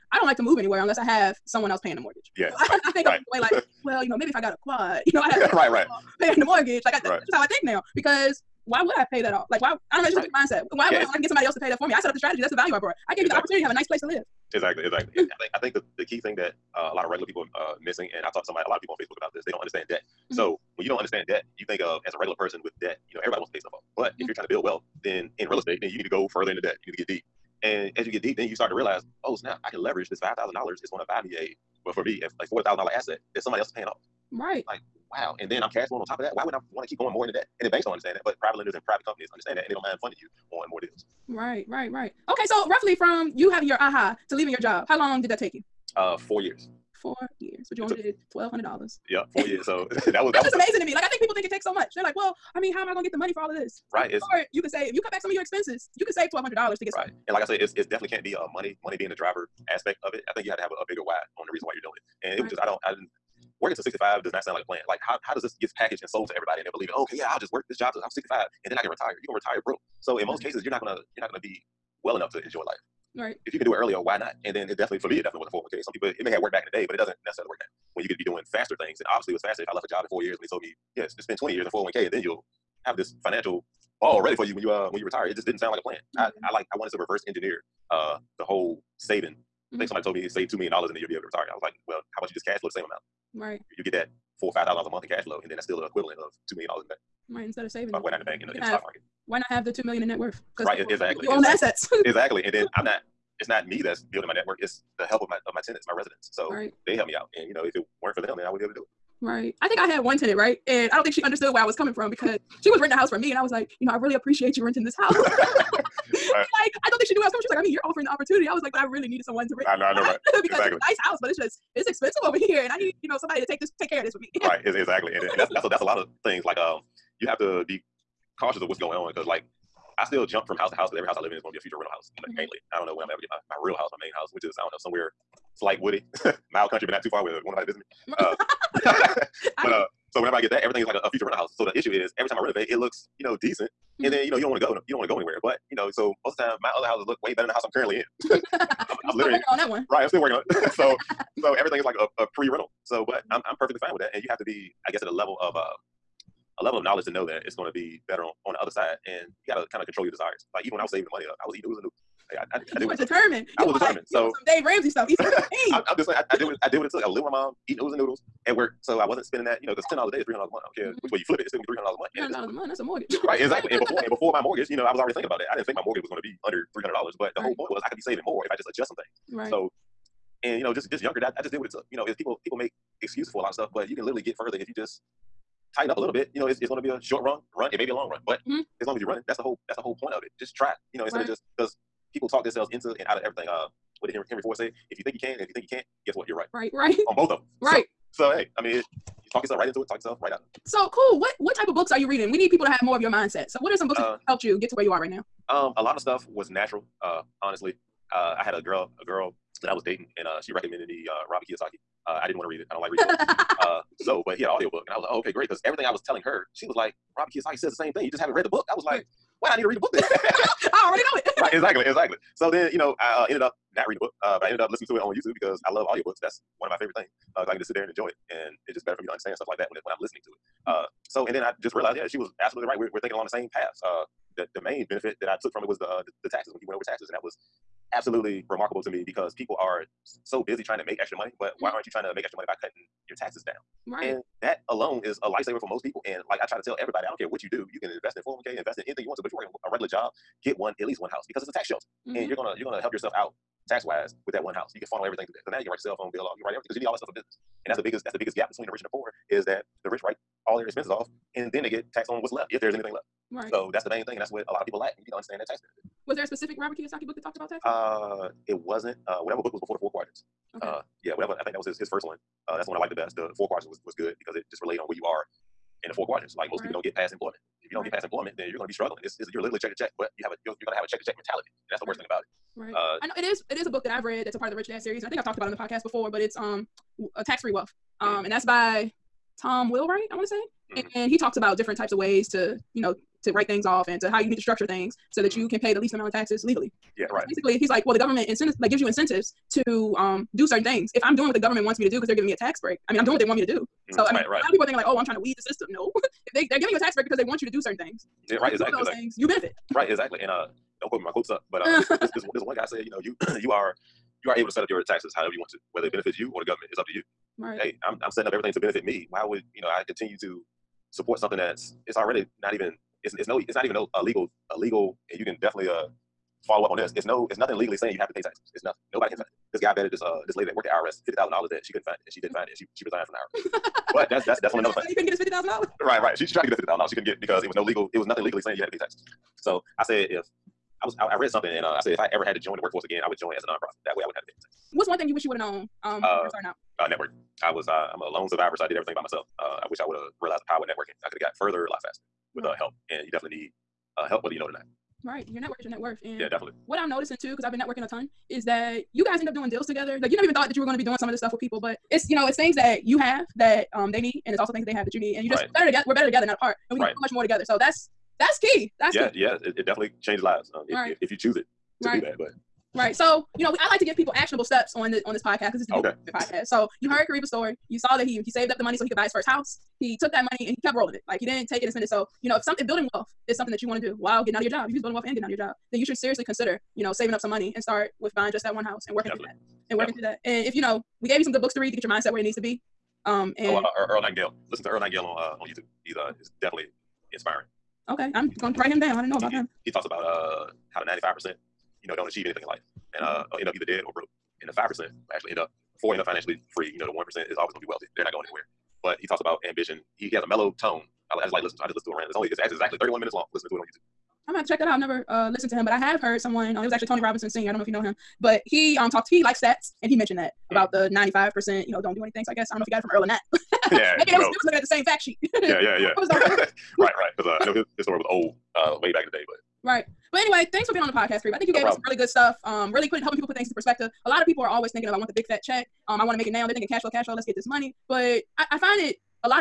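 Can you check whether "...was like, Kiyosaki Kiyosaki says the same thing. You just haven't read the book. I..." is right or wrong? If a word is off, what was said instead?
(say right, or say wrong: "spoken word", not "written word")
wrong: "Robert", not "Kiyosaki".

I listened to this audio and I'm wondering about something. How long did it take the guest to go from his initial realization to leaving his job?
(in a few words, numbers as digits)
4 years.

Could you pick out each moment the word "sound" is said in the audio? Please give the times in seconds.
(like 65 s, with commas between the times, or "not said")
64 s, 85 s.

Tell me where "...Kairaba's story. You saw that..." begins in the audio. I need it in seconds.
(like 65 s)
377 s.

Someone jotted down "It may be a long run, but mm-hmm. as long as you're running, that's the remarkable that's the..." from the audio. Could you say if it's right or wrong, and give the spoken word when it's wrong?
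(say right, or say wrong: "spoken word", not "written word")
wrong: "whole", not "remarkable".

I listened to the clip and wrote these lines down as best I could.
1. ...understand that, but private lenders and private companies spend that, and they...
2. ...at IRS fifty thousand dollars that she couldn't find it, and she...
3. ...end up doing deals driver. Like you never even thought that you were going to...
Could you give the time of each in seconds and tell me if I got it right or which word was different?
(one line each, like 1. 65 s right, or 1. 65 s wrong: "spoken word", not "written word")
1. 37 s wrong: "understand", not "spend"
2. 330 s right
3. 359 s wrong: "together", not "driver".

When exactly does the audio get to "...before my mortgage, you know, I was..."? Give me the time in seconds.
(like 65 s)
174 s.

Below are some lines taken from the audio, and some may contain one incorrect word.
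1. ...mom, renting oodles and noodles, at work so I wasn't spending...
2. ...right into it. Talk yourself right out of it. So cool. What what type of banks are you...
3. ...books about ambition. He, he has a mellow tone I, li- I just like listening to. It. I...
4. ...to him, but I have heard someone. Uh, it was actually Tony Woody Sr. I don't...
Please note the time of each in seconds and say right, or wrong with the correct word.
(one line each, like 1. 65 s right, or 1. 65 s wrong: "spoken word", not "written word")
1. 167 s wrong: "eating", not "renting"
2. 199 s wrong: "books", not "banks"
3. 409 s wrong: "talks", not "books"
4. 415 s wrong: "Robinson", not "Woody".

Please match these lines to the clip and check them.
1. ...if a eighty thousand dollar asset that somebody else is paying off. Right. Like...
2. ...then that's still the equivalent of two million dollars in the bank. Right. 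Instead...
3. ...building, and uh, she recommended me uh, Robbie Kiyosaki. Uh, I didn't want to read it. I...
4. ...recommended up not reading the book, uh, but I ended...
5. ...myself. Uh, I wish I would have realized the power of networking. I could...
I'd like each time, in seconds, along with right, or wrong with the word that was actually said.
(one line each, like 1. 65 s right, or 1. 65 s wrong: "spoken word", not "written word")
1. 32 s wrong: "forty", not "eighty"
2. 95 s right
3. 209 s wrong: "dating", not "building"
4. 223 s wrong: "ended", not "recommended"
5. 349 s right.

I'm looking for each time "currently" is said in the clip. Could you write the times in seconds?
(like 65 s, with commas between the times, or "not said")
147 s.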